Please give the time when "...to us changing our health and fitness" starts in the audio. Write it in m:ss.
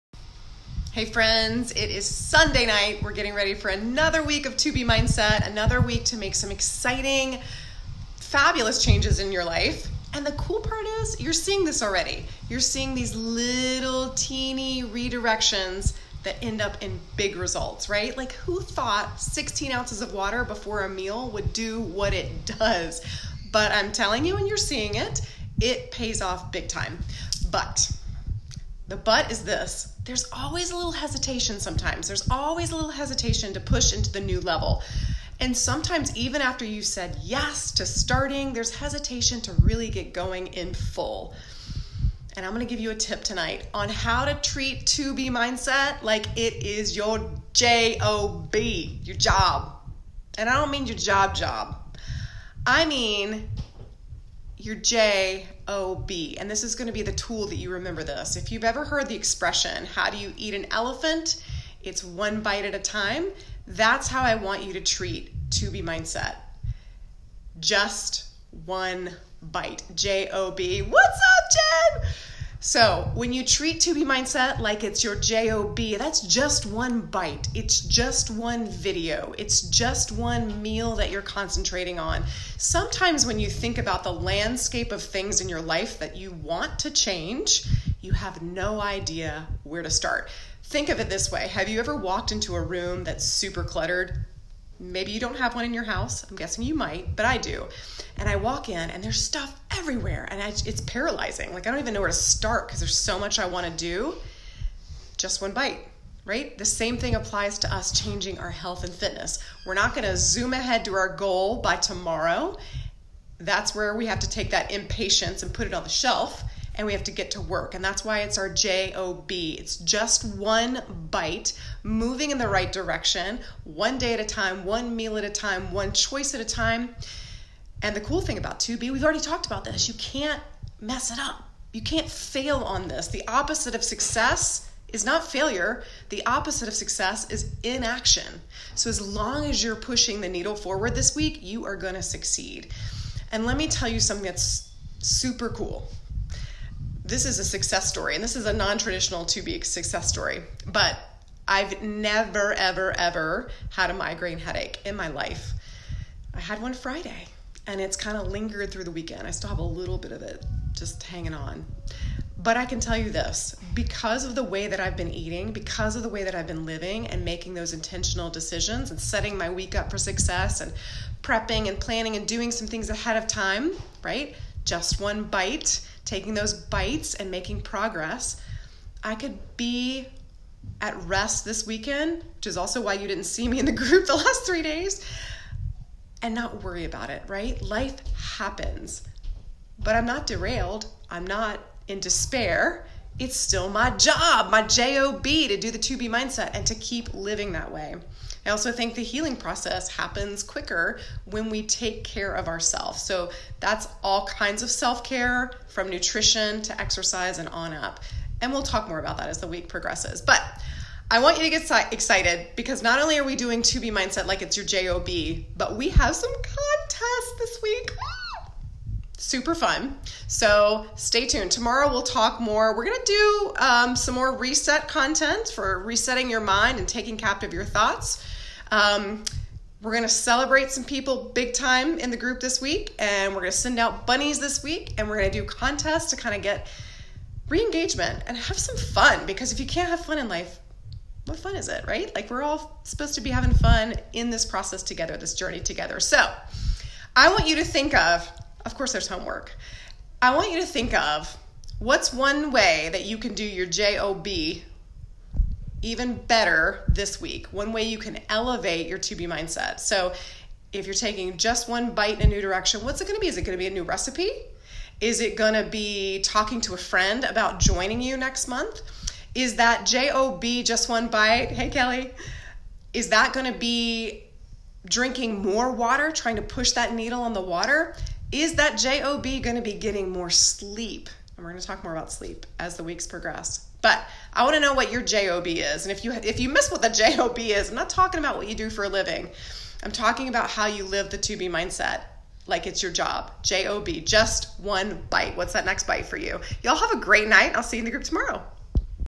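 1:47.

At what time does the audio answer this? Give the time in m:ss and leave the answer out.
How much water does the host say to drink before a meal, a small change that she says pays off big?
0:19.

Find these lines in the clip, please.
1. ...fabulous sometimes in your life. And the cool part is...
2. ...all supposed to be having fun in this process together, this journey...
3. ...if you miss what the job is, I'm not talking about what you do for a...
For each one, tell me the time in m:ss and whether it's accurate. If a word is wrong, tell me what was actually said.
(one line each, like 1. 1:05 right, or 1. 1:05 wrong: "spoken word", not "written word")
1. 0:08 wrong: "changes", not "sometimes"
2. 4:02 right
3. 4:46 right.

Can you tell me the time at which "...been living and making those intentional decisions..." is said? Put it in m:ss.
2:46.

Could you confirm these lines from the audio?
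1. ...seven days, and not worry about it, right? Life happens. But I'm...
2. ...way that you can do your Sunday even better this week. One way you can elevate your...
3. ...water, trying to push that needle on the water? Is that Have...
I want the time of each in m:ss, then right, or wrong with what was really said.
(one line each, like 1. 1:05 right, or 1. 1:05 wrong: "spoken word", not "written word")
1. 3:04 wrong: "three", not "seven"
2. 4:12 wrong: "JOB", not "Sunday"
3. 4:35 wrong: "JOB", not "Have".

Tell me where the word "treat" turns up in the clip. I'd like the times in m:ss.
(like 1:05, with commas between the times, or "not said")
0:44, 1:04, 1:13.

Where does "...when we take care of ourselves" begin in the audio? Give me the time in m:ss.
3:21.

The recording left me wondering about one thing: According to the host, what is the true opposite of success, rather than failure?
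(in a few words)
Inaction.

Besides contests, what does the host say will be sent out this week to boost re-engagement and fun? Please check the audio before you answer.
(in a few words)
Bunnies.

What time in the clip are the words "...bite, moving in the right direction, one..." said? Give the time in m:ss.
2:01.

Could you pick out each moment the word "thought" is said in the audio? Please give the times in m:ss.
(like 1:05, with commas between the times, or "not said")
0:18, 3:47.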